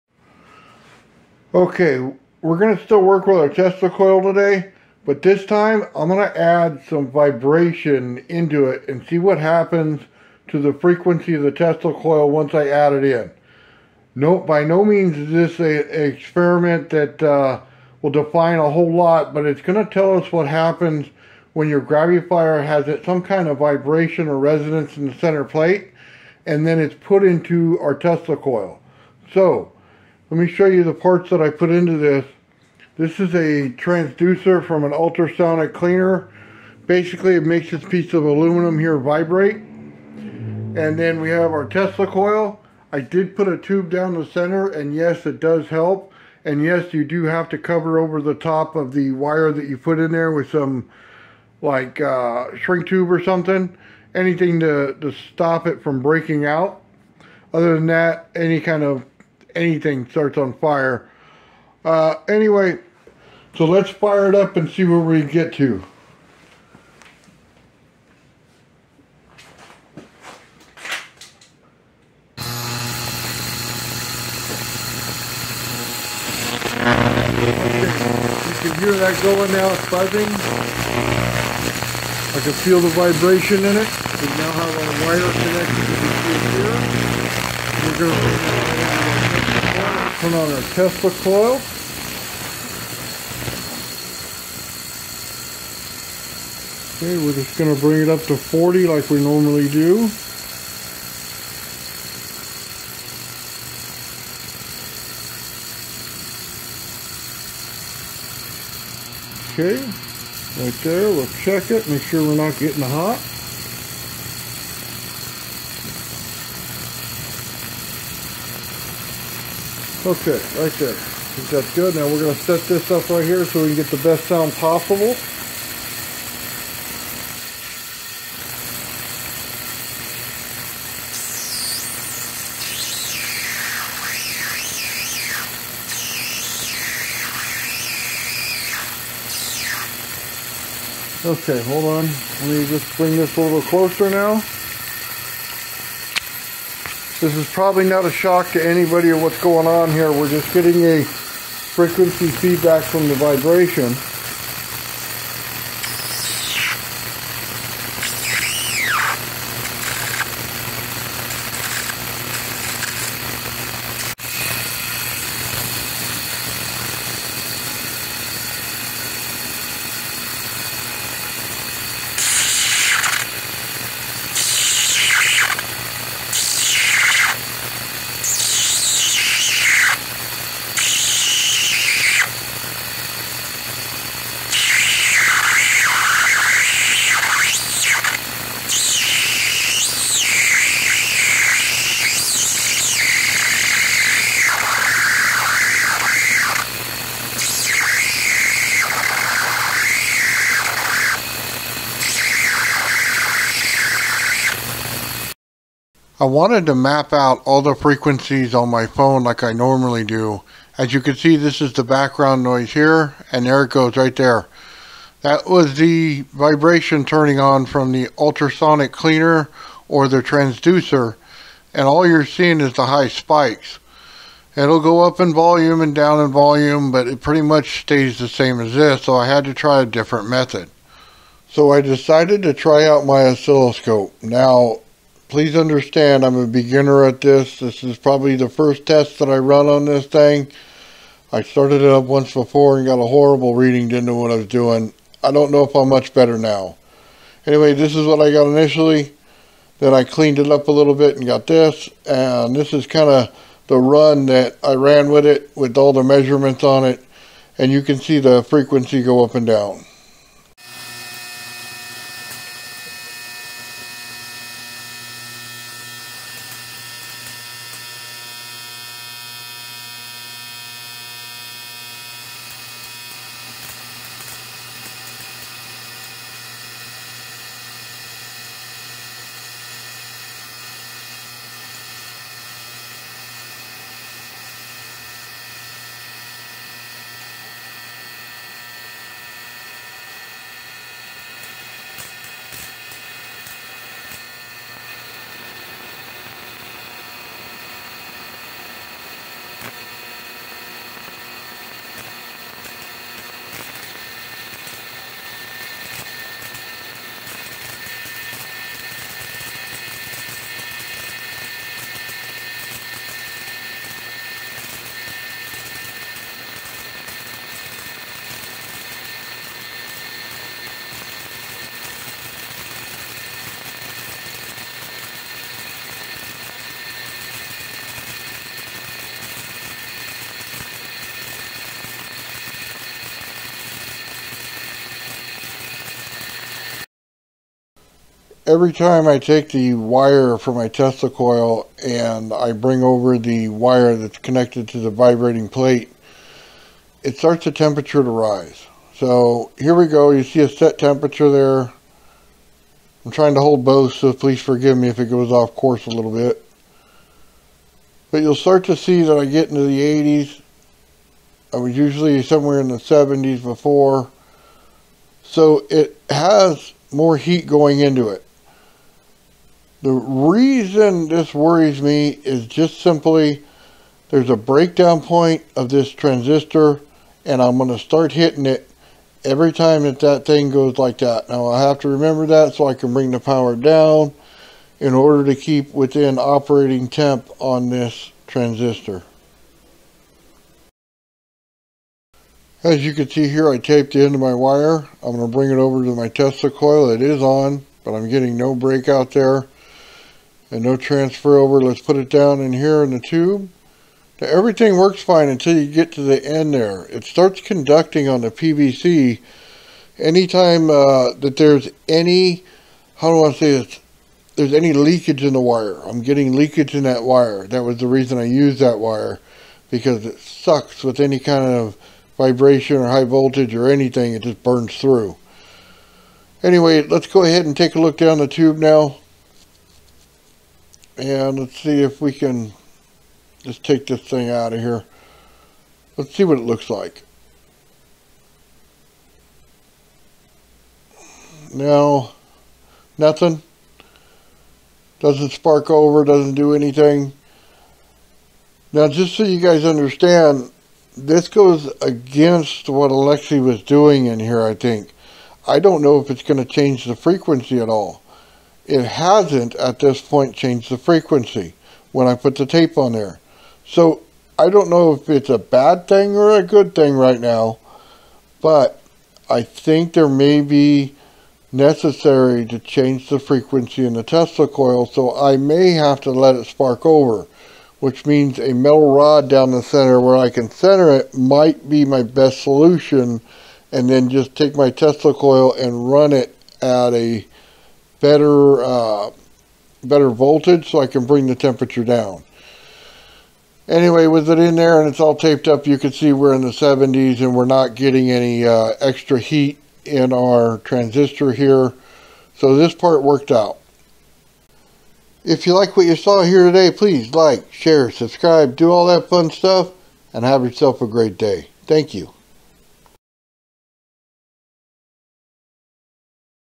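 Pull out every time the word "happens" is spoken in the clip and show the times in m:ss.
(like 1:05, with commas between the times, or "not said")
0:09, 0:20.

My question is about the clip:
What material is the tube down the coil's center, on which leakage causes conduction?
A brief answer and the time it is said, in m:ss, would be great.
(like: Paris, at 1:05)
PVC, at 6:48.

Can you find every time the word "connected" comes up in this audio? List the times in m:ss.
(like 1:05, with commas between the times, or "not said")
1:25, 5:44.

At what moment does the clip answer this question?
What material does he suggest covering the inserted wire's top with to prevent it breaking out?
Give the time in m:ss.
0:52.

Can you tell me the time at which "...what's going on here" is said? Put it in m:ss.
2:29.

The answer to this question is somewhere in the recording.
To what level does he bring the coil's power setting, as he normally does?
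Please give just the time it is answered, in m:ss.
1:38.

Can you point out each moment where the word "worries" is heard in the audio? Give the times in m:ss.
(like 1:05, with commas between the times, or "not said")
6:11.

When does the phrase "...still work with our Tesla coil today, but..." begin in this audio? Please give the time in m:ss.
0:02.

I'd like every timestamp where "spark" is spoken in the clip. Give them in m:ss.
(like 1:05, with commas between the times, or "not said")
7:25, 7:56.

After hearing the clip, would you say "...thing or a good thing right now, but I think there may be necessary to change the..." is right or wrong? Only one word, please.
right.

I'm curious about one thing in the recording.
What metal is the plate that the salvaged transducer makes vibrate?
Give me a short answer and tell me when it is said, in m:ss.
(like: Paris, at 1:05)
aluminum, at 0:38.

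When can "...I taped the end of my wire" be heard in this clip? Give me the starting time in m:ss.
6:33.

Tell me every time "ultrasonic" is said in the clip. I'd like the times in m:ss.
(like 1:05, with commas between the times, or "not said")
0:34, 3:38.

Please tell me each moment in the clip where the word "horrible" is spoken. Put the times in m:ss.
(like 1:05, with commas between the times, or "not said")
4:03.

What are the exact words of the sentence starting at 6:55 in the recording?
I'm getting leakage in that wire.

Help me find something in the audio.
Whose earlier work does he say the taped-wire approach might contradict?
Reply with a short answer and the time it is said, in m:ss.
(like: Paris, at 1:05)
Alexi, at 7:32.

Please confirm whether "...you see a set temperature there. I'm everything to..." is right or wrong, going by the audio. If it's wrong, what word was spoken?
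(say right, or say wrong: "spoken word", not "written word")
wrong: "trying", not "everything".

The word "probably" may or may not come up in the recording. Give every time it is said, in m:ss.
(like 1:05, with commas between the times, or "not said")
2:27, 3:57.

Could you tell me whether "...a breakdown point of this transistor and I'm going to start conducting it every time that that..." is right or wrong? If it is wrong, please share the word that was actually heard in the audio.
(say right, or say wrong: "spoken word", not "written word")
wrong: "hitting", not "conducting".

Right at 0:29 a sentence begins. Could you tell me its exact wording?
So, let me show you the parts that I put into this.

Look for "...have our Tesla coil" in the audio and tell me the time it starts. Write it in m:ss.
0:41.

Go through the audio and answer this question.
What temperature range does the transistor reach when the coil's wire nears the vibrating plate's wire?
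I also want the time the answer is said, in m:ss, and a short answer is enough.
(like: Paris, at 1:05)
the 80s, at 5:59.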